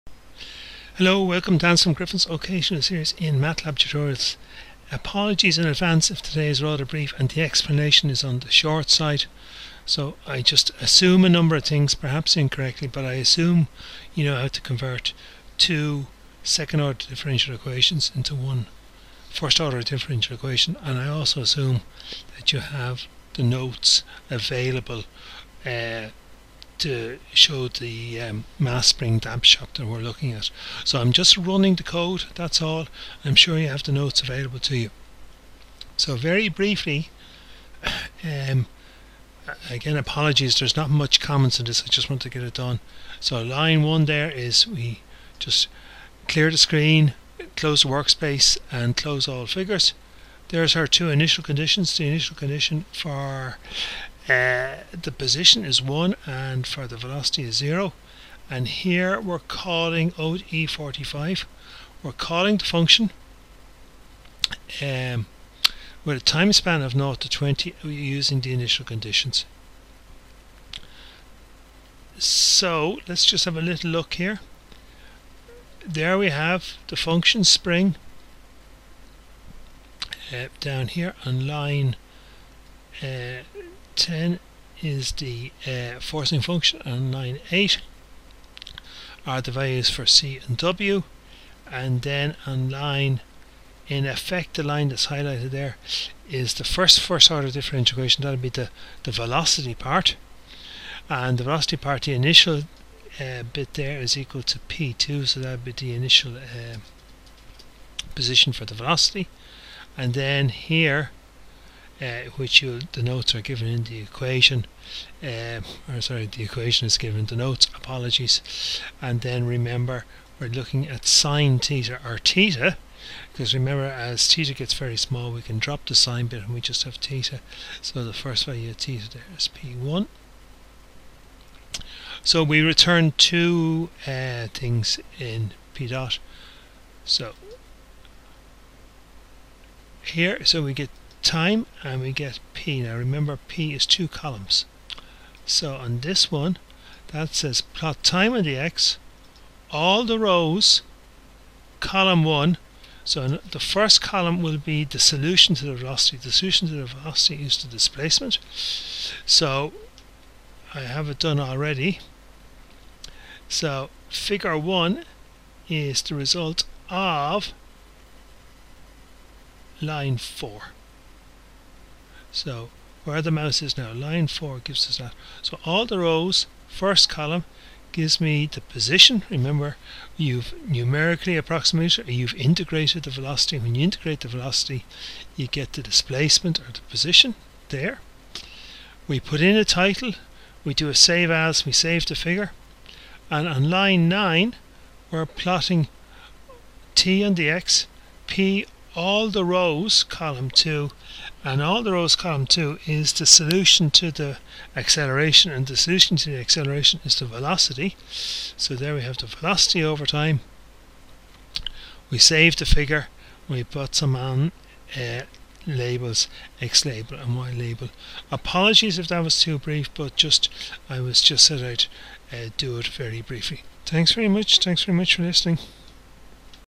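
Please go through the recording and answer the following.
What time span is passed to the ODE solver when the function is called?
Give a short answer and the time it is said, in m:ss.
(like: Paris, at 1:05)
0 to 20, at 1:06.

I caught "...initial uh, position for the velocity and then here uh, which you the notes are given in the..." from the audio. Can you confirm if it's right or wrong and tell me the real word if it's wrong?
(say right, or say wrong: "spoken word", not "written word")
right.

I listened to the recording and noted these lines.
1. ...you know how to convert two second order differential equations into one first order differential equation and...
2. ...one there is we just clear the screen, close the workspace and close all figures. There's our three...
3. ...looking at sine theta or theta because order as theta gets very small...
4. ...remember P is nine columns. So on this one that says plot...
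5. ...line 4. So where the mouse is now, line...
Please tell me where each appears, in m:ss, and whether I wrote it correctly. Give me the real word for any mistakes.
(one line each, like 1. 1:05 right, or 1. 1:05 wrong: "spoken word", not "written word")
1. 0:14 right
2. 0:43 wrong: "two", not "three"
3. 2:00 wrong: "remember", not "order"
4. 2:22 wrong: "two", not "nine"
5. 2:49 right.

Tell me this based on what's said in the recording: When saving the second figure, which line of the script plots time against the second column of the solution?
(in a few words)
Line 9.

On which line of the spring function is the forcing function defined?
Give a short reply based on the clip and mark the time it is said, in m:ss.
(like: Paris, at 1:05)
Line 10, at 1:23.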